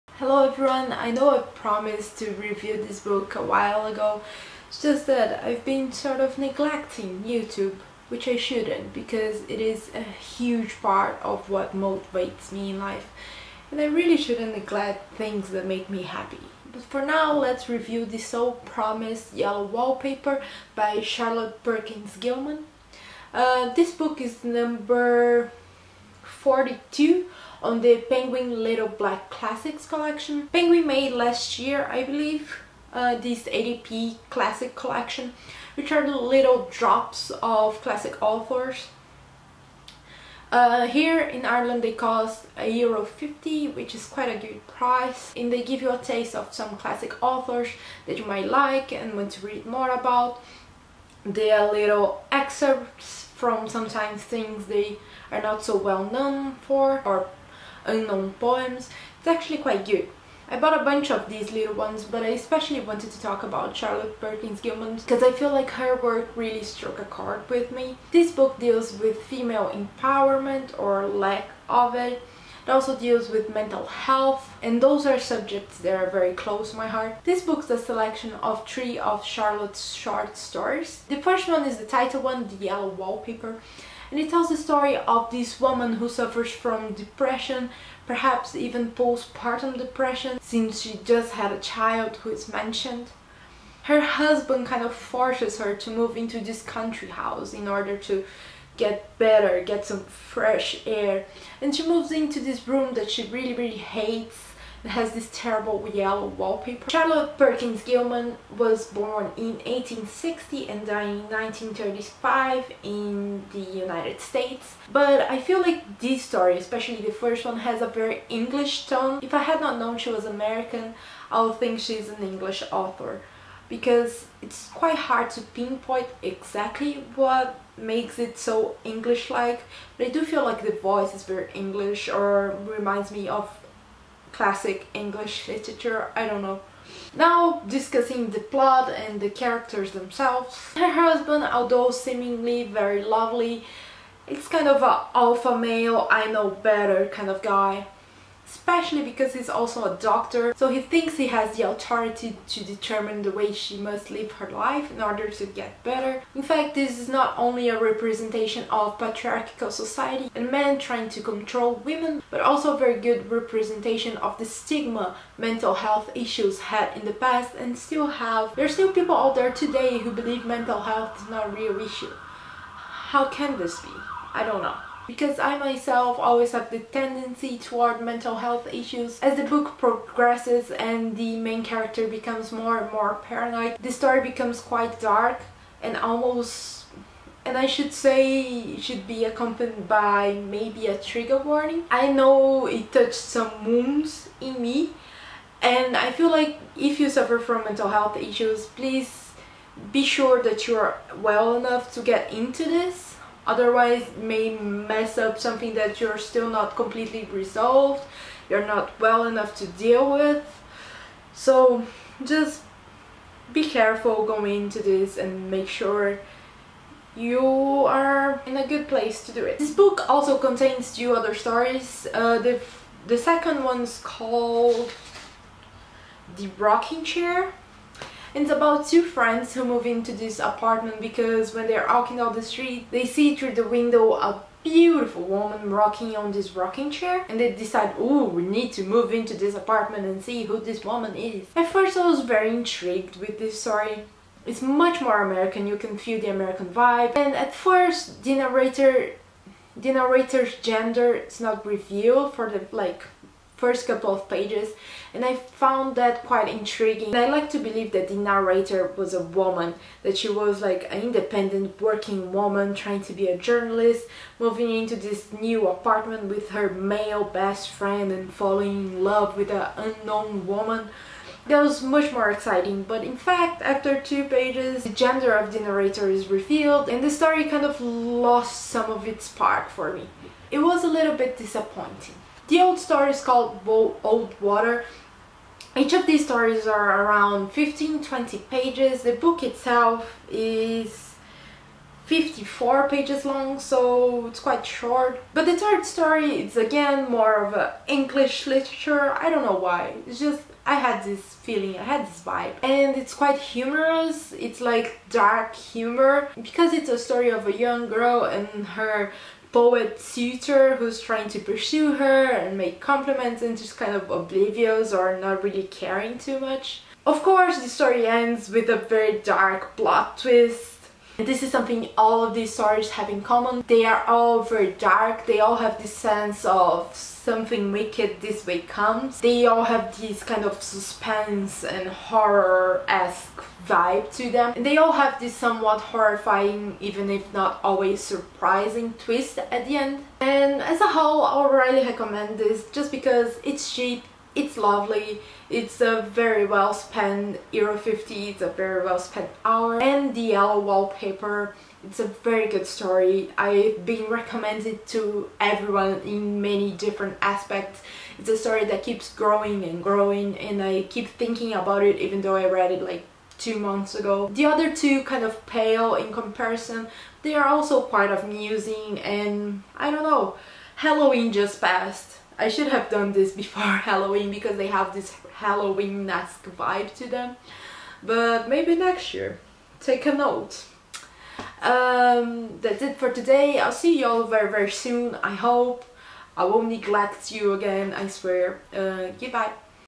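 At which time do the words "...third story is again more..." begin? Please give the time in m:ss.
4:55.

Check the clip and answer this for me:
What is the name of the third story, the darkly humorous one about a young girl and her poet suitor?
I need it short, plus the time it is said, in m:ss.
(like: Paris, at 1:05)
Old Water, at 4:43.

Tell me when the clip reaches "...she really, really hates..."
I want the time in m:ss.
1:43.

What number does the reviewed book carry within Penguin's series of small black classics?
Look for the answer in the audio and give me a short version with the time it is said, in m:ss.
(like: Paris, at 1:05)
42, at 0:26.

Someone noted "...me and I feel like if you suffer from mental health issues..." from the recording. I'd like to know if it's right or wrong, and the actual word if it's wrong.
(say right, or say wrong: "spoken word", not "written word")
right.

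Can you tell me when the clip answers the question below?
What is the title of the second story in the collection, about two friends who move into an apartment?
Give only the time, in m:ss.
3:46.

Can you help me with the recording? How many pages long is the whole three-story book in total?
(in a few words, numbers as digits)
54.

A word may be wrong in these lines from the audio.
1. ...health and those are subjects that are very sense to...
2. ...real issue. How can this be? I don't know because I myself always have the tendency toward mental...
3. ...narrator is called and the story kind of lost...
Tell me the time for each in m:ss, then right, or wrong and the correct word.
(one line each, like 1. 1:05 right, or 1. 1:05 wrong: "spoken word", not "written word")
1. 1:13 wrong: "close", not "sense"
2. 2:51 right
3. 4:35 wrong: "revealed", not "called".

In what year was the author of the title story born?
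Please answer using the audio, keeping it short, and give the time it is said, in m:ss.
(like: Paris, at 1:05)
1860, at 1:49.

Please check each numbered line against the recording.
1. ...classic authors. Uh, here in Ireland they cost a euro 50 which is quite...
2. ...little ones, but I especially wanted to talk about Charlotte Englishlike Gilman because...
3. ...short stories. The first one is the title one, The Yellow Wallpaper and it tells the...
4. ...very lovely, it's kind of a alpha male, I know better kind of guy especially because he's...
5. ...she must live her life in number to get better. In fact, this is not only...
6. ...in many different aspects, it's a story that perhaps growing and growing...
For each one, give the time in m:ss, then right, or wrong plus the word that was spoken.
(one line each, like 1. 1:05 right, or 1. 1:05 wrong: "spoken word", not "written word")
1. 0:37 right
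2. 1:01 wrong: "Perkins", not "Englishlike"
3. 1:19 right
4. 2:22 right
5. 2:33 wrong: "order", not "number"
6. 5:56 wrong: "keeps", not "perhaps".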